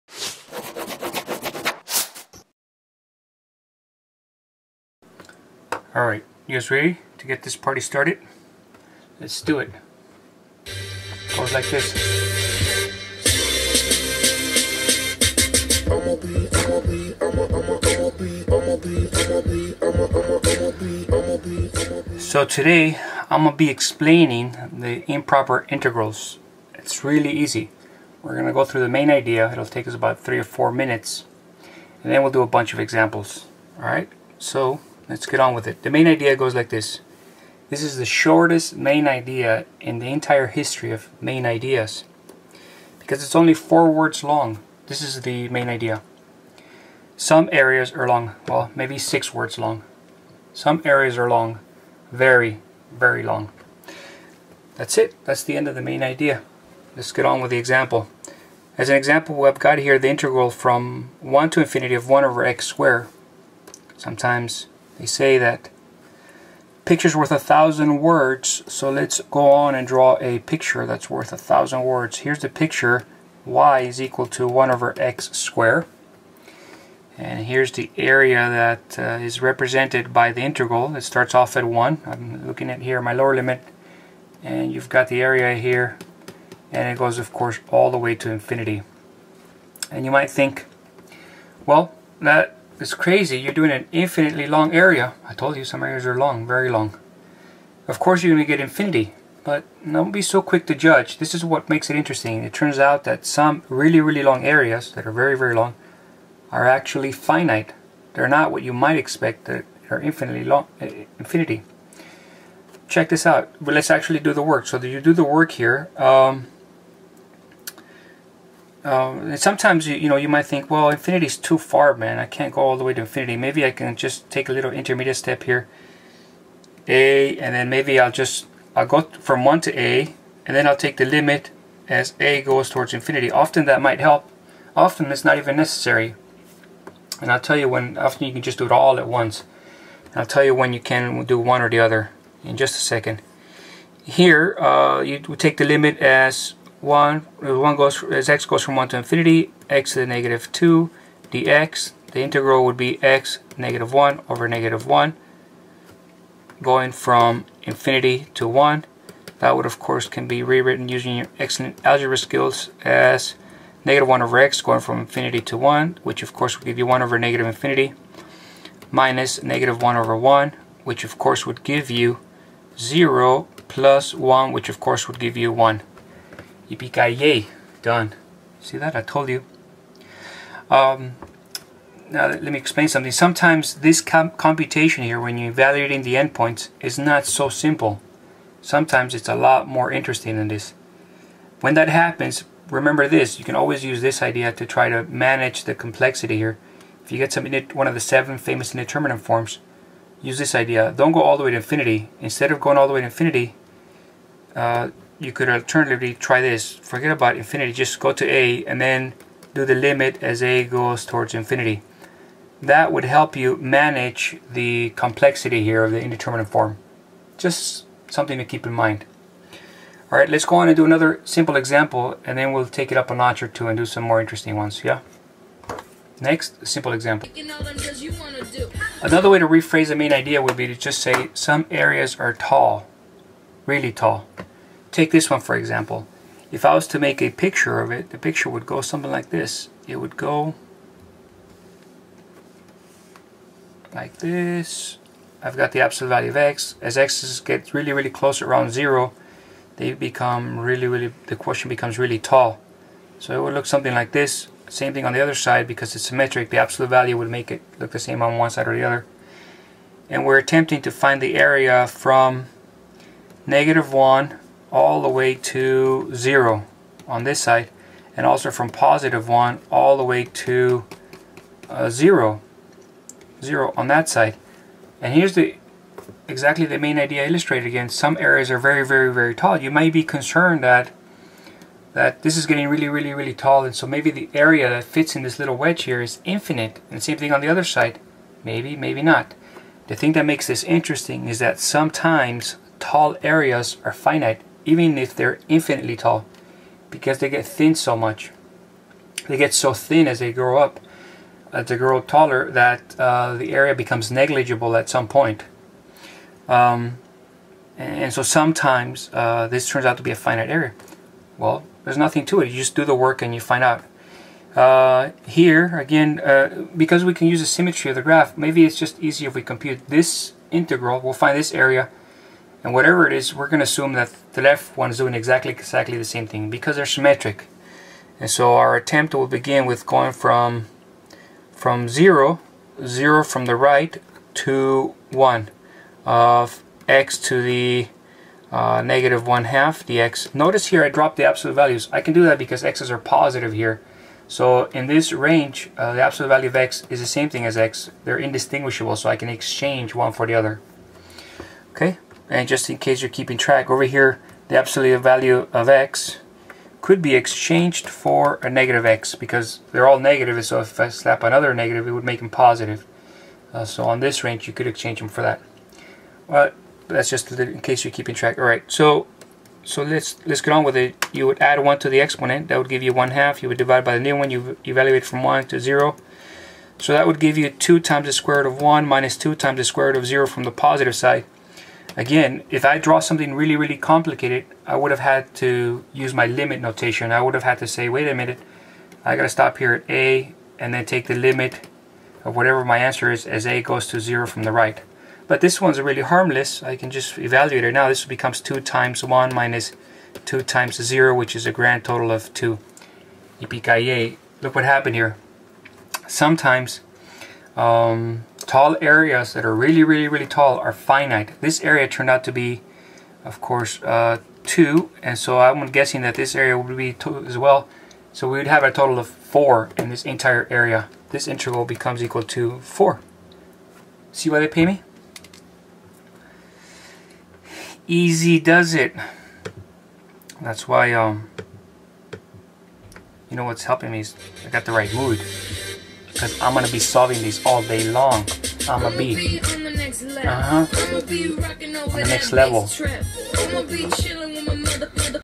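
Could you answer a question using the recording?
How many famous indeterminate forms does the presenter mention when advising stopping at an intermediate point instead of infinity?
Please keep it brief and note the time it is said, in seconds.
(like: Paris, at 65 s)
7, at 197 s.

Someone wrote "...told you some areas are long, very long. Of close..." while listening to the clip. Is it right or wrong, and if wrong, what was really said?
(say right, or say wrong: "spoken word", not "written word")
wrong: "course", not "close".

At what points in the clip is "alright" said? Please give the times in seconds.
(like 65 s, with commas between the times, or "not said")
5 s, 33 s, 220 s, 368 s.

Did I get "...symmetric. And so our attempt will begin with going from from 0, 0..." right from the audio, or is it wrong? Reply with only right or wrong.
right.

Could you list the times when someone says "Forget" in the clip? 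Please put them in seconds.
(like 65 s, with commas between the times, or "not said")
206 s.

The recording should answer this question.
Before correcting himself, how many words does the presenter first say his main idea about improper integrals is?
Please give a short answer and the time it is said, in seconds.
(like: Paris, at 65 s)
4, at 43 s.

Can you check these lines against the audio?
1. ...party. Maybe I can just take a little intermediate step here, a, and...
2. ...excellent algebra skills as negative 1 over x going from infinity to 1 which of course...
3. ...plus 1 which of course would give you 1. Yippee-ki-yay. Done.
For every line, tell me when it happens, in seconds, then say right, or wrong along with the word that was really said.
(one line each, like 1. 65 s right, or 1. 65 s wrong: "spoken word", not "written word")
1. 123 s wrong: "infinity", not "party"
2. 161 s right
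3. 173 s right.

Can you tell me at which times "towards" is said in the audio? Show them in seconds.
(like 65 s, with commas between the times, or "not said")
132 s, 211 s.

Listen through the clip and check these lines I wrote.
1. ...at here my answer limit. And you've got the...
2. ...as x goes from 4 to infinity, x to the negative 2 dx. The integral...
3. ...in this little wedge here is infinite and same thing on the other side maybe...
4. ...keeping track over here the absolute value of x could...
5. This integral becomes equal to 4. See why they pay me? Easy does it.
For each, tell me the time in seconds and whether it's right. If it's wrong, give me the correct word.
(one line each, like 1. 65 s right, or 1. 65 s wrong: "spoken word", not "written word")
1. 82 s wrong: "lower", not "answer"
2. 148 s wrong: "1", not "4"
3. 285 s right
4. 353 s right
5. 421 s right.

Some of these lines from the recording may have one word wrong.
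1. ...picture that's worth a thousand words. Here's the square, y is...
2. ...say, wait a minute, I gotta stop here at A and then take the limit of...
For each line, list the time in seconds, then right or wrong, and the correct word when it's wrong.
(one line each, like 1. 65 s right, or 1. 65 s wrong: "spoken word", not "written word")
1. 70 s wrong: "picture", not "square"
2. 387 s right.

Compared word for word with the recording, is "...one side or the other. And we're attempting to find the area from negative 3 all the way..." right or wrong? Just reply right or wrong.
wrong.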